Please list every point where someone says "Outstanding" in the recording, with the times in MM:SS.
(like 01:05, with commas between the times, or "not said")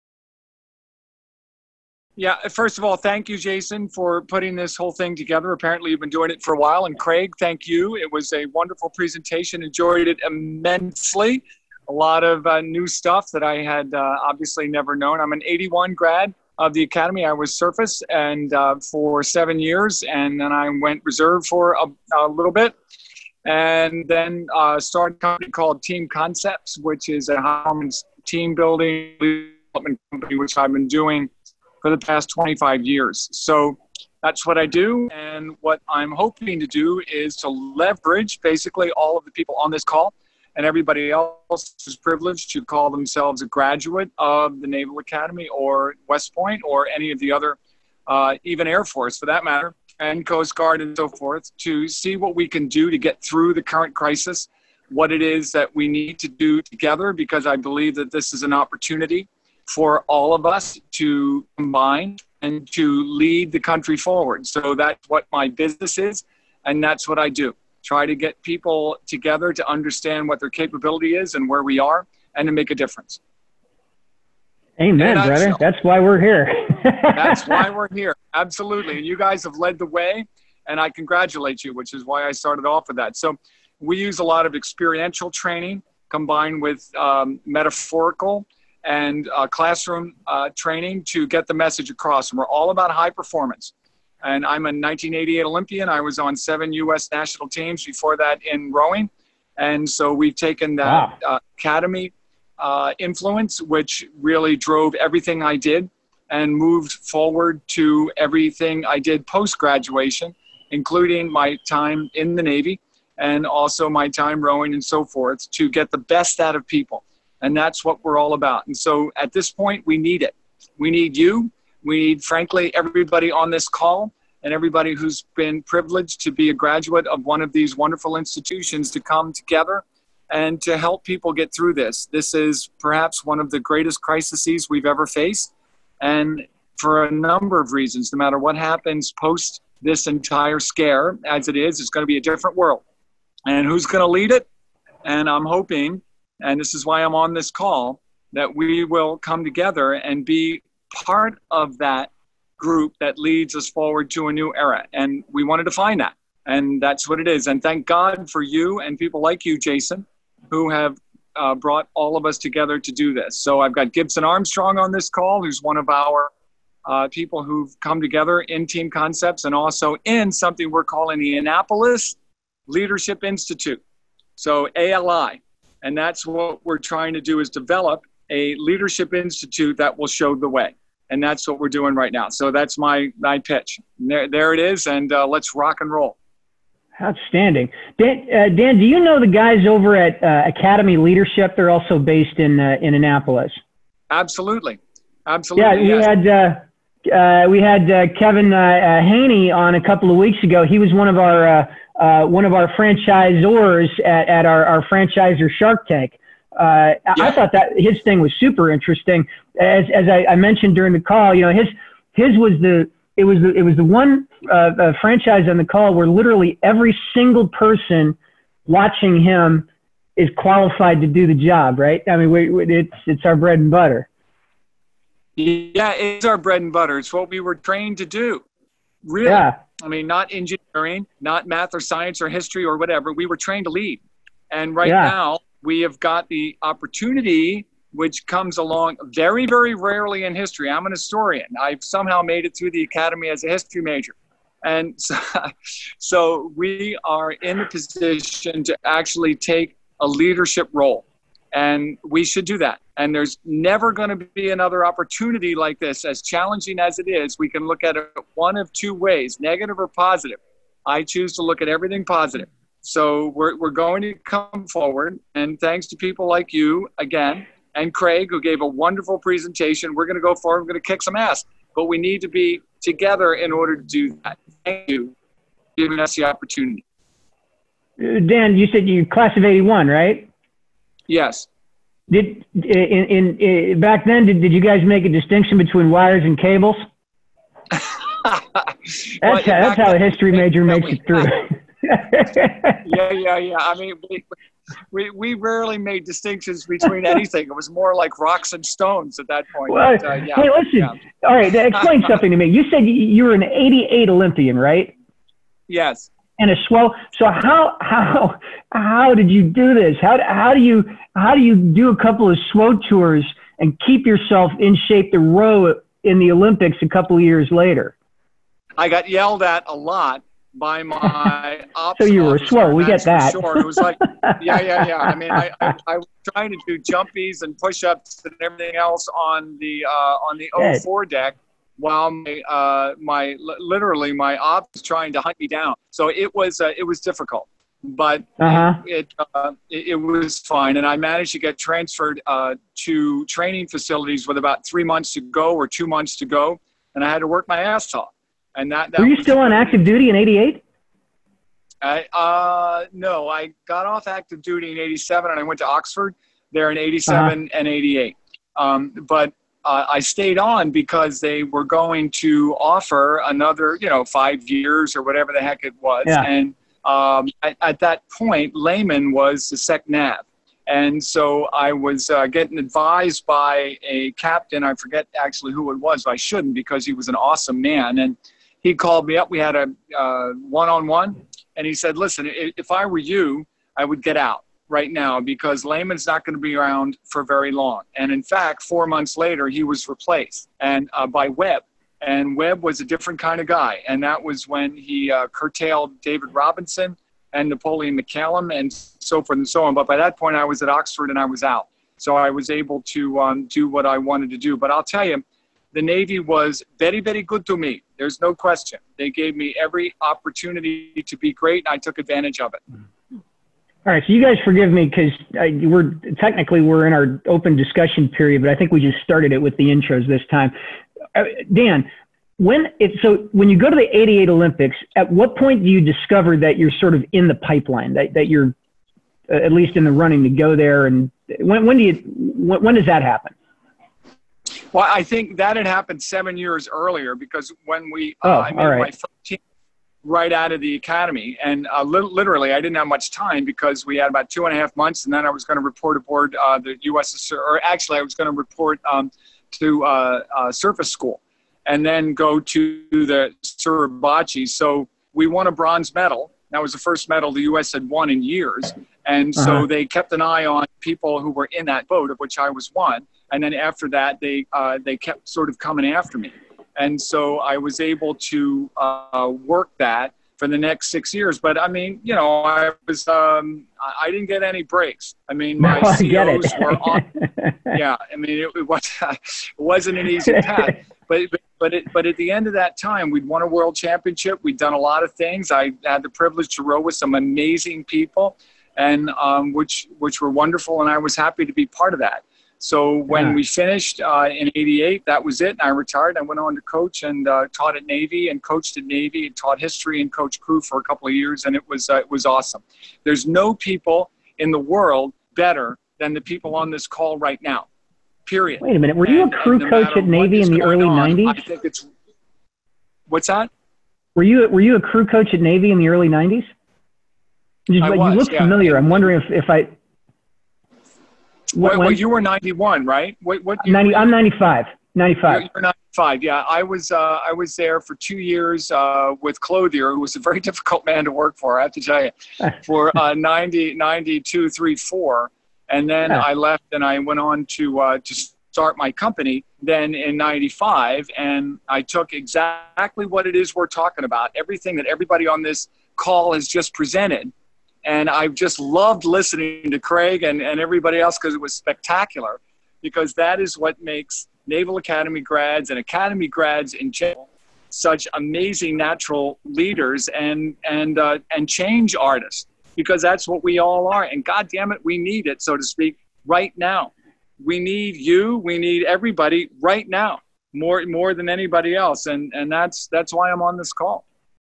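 03:07.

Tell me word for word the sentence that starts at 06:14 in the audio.
I forget actually who it was.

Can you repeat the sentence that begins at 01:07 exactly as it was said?
Try to get people together to understand what their capability is and where we are, and to make a difference.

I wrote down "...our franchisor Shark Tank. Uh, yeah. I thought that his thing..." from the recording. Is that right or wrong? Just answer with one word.
right.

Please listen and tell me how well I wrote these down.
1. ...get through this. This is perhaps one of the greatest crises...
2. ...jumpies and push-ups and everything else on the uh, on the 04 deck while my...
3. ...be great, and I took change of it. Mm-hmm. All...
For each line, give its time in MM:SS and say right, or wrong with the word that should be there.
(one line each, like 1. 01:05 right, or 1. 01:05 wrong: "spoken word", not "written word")
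1. 02:11 right
2. 05:26 right
3. 06:51 wrong: "advantage", not "change".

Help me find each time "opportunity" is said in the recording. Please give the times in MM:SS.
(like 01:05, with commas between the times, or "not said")
00:58, 03:56, 04:14, 04:36, 06:50.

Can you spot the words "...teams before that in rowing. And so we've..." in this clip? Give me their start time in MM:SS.
01:37.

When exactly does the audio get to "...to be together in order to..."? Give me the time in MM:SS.
04:32.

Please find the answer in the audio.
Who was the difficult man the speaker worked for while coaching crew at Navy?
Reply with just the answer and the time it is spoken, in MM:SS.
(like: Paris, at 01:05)
Clothier, at 08:49.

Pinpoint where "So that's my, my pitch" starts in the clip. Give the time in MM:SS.
03:02.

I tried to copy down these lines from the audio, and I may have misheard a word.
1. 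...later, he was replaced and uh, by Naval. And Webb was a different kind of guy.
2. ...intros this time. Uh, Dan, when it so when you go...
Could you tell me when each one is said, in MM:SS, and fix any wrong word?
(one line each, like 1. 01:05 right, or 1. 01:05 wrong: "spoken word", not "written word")
1. 06:29 wrong: "Webb", not "Naval"
2. 06:59 right.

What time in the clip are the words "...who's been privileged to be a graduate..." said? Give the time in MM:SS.
02:04.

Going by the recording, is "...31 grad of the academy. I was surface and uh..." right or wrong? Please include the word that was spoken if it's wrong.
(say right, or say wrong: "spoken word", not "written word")
wrong: "81", not "31".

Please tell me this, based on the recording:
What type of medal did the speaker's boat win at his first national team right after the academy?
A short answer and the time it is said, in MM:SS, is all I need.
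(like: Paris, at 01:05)
bronze, at 07:35.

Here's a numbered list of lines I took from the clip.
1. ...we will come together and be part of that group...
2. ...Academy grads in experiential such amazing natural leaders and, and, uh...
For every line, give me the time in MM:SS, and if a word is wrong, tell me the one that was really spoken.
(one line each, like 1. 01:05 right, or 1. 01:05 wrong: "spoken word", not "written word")
1. 02:28 right
2. 09:15 wrong: "general", not "experiential".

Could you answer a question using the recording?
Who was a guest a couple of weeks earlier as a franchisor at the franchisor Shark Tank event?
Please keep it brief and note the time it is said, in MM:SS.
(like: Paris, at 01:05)
Kevin Haney, at 03:18.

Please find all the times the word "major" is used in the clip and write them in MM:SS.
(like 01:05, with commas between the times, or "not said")
04:03, 04:50.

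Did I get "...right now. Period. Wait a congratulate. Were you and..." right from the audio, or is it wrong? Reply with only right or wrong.
wrong.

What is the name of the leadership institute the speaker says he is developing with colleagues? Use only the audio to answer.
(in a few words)
Annapolis Leadership Institute.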